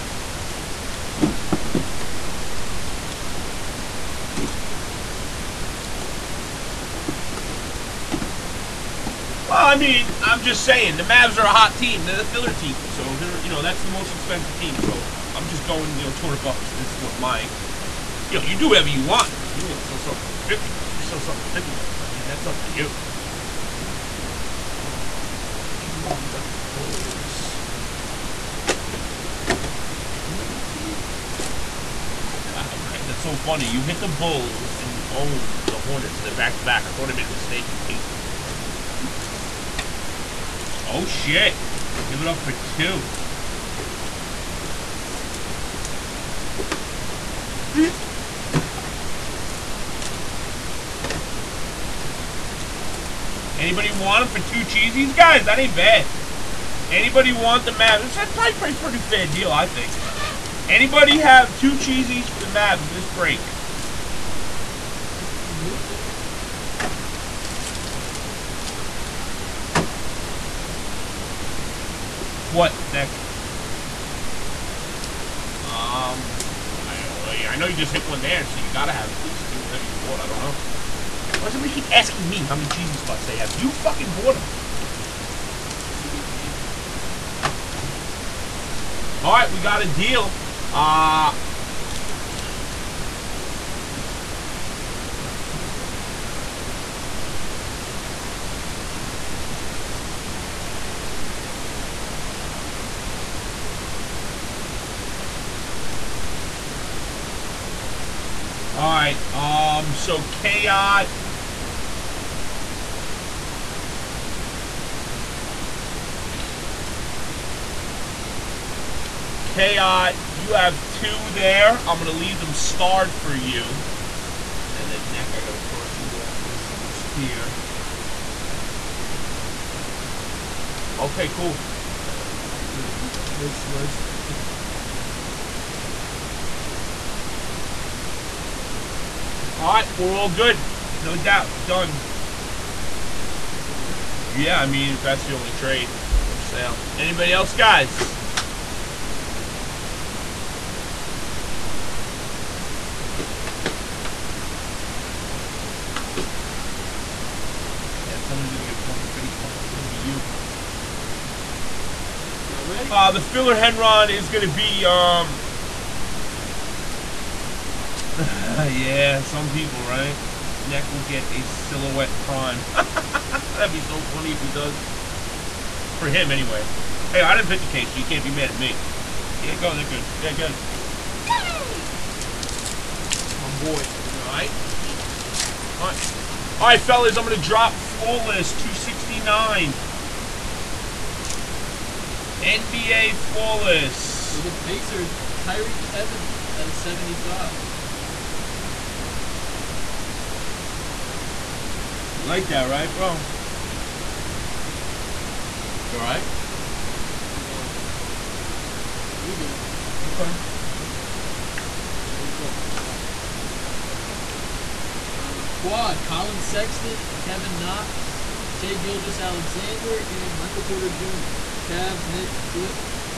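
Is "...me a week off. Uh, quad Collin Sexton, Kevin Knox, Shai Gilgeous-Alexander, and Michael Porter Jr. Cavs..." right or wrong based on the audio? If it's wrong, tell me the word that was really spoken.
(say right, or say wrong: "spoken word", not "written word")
right.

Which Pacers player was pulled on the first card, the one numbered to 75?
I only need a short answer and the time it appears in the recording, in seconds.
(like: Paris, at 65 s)
Tyreke Evans, at 195 s.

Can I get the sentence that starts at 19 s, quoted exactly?
I mean, you want to sell something for 50 bucks, you sell something 50 bucks.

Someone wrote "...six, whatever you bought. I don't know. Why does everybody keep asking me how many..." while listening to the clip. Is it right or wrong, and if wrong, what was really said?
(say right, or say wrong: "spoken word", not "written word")
wrong: "two", not "six".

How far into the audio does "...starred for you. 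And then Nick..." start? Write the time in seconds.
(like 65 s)
122 s.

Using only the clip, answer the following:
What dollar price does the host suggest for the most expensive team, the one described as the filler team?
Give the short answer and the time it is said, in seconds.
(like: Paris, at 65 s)
$200, at 16 s.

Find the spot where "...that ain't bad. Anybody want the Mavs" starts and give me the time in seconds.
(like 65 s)
55 s.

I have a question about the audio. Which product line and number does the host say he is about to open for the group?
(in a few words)
NBA Flawless 269.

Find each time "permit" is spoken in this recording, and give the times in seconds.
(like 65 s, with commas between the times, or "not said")
not said.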